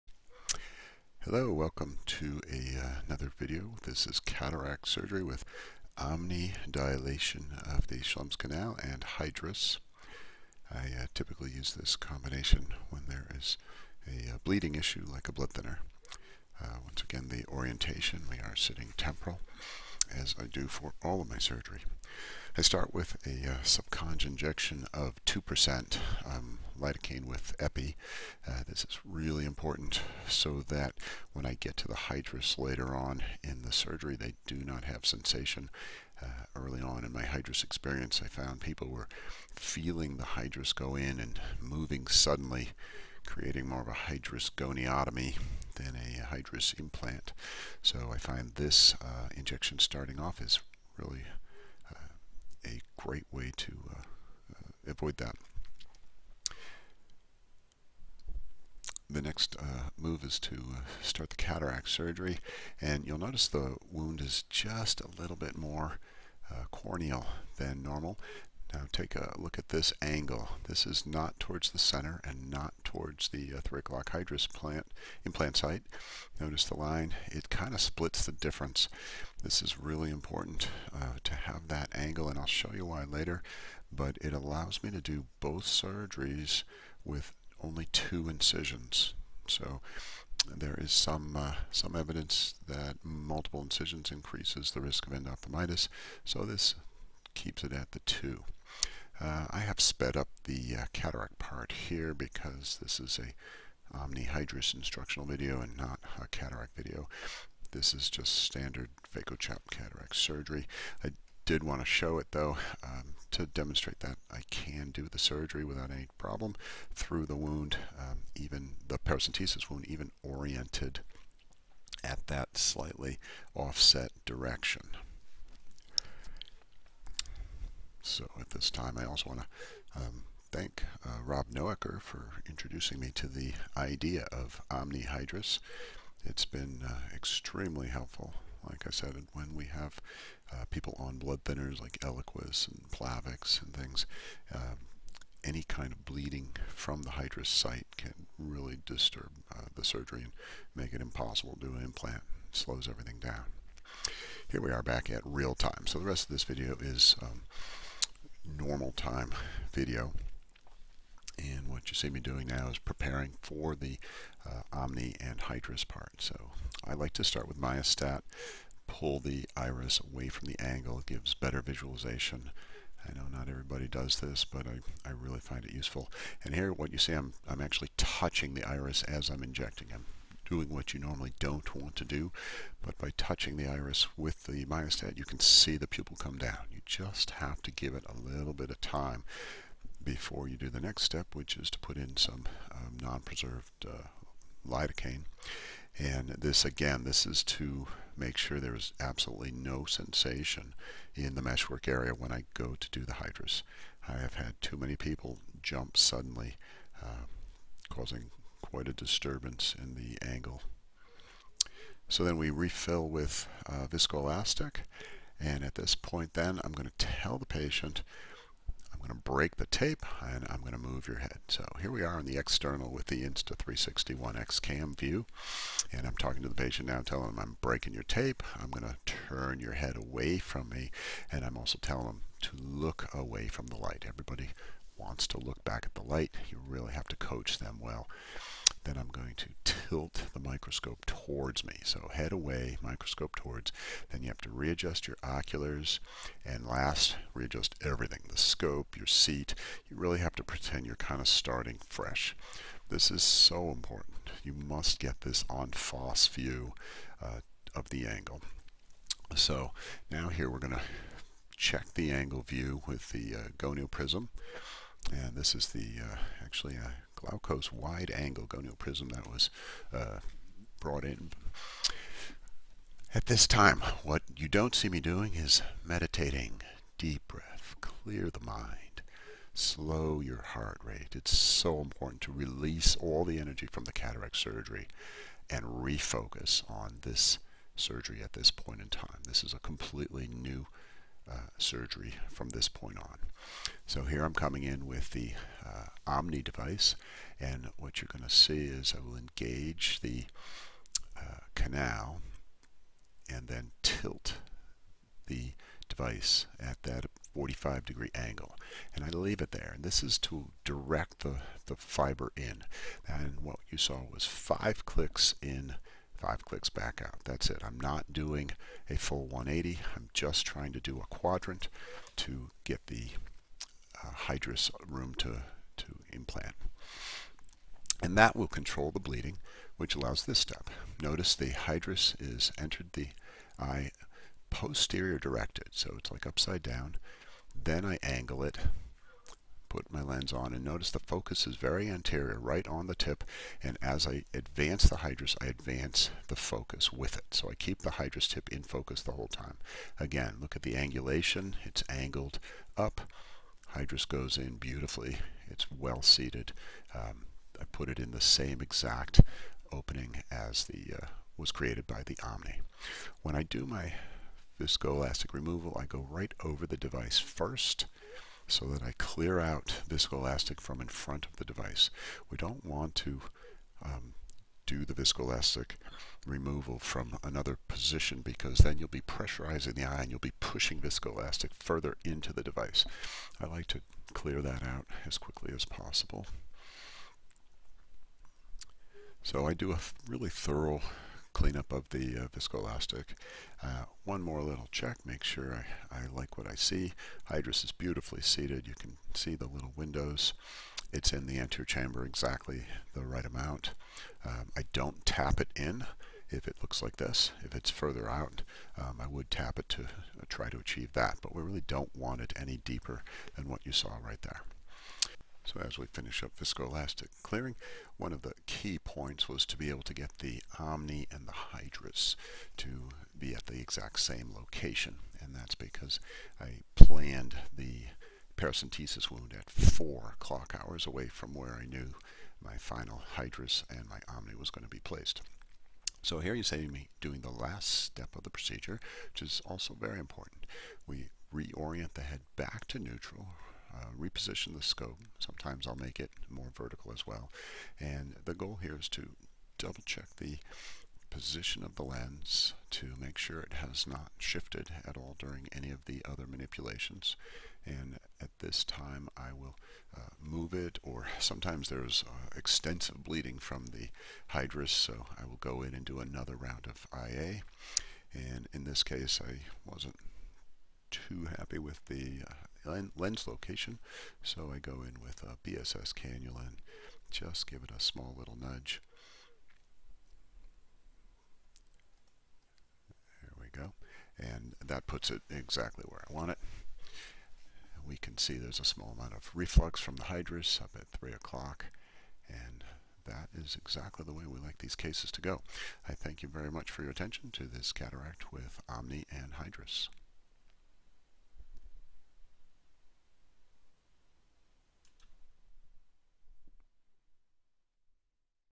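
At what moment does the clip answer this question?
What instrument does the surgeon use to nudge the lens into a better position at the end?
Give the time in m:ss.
7:55.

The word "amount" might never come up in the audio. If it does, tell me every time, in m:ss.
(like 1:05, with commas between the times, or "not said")
6:43, 8:08.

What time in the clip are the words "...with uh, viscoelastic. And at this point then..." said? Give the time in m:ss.
3:33.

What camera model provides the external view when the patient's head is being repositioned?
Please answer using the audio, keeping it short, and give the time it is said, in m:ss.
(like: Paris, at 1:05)
Insta360 One X, at 3:43.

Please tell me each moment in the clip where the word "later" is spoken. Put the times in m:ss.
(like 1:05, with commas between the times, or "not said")
0:32, 1:23.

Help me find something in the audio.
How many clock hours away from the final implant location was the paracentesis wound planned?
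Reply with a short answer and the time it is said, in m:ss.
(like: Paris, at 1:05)
4, at 7:09.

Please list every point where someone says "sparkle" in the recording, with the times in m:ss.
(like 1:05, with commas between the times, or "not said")
not said.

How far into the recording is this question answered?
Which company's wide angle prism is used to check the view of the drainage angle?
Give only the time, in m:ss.
4:27.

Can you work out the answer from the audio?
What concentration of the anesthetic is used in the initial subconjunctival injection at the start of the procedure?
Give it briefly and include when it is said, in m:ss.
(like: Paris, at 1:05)
2%, at 0:25.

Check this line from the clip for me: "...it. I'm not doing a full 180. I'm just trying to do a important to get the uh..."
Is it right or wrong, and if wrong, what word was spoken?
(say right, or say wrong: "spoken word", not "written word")
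wrong: "quadrant", not "important".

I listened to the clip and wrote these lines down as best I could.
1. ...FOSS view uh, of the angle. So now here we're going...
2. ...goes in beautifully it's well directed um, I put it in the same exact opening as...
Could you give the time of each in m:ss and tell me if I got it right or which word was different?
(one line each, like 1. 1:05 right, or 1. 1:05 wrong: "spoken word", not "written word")
1. 4:15 right
2. 5:54 wrong: "seated", not "directed".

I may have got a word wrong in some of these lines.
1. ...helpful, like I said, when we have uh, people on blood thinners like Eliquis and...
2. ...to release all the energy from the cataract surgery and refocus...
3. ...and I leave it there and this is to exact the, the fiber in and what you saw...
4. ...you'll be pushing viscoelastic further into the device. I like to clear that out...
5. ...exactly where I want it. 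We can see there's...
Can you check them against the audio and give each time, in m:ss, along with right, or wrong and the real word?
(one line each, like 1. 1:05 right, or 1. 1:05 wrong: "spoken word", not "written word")
1. 2:17 right
2. 4:42 right
3. 5:08 wrong: "direct", not "exact"
4. 6:20 right
5. 8:05 right.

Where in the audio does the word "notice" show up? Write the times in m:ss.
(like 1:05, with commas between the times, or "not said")
1:03, 1:16, 5:31, 5:40.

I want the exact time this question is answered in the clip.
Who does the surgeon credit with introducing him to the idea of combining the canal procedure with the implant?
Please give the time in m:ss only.
2:11.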